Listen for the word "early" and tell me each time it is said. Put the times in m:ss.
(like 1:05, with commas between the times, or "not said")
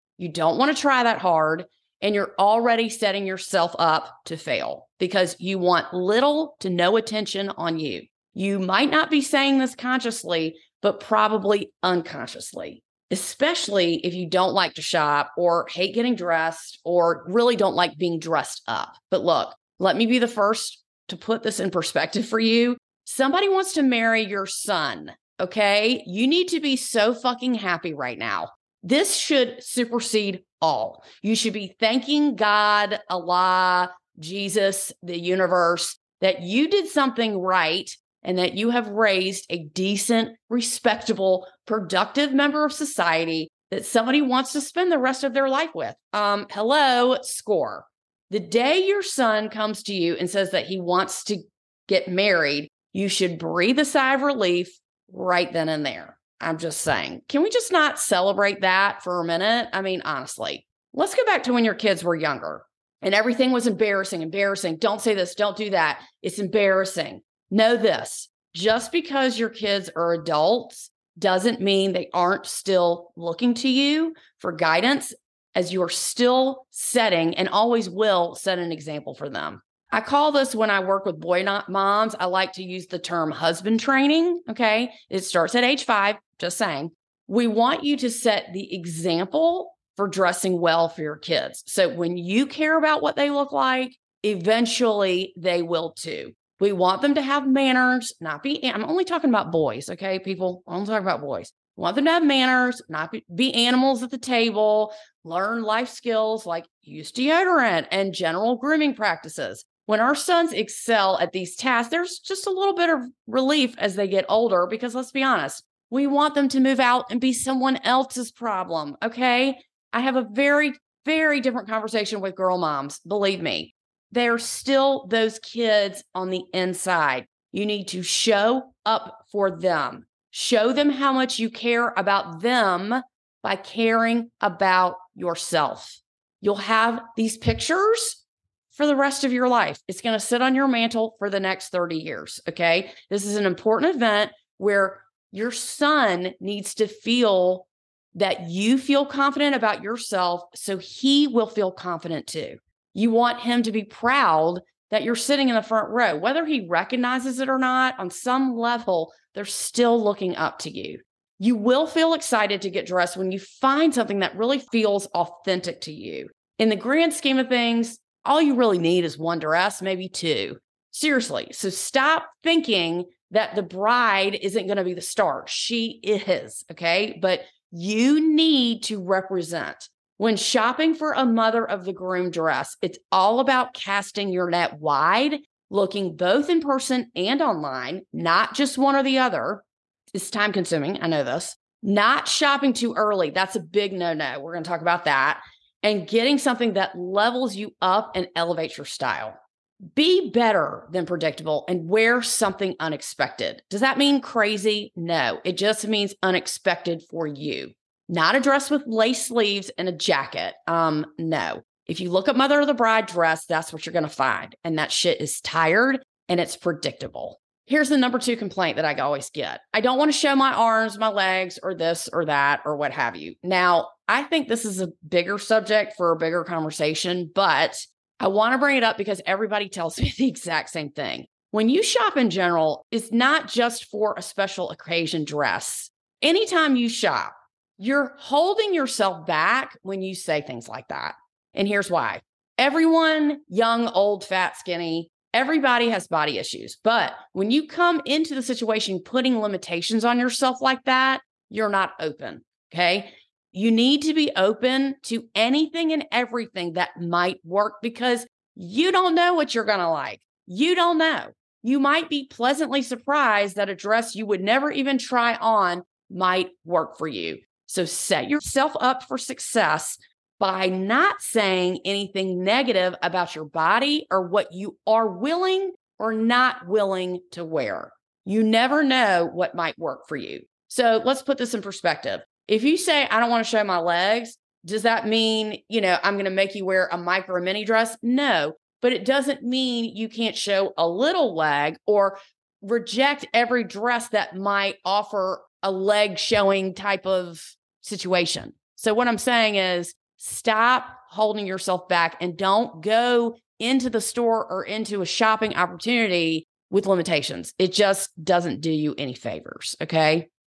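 3:12.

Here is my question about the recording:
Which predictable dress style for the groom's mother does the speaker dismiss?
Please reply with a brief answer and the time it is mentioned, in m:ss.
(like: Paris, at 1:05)
lace sleeves, at 3:28.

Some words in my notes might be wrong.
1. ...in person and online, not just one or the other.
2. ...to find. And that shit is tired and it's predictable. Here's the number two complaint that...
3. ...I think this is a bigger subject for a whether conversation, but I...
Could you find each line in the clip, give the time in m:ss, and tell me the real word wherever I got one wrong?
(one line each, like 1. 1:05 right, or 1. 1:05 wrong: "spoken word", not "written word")
1. 3:06 right
2. 3:34 right
3. 3:44 wrong: "bigger", not "whether".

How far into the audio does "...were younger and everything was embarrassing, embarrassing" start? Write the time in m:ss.
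1:02.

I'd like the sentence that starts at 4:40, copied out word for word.
So let's put this in perspective.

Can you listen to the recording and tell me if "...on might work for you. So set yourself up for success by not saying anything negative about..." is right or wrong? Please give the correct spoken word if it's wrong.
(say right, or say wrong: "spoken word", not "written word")
right.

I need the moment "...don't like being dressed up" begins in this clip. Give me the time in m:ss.
0:17.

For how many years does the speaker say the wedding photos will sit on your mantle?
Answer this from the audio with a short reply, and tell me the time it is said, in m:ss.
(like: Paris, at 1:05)
30, at 2:21.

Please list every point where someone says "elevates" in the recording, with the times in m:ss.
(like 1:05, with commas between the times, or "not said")
3:18.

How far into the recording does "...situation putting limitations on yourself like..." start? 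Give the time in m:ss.
4:08.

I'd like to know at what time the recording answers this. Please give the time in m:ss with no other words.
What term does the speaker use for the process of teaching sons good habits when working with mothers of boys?
1:23.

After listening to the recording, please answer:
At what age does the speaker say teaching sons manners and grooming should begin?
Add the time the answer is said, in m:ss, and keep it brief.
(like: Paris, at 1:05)
5, at 1:25.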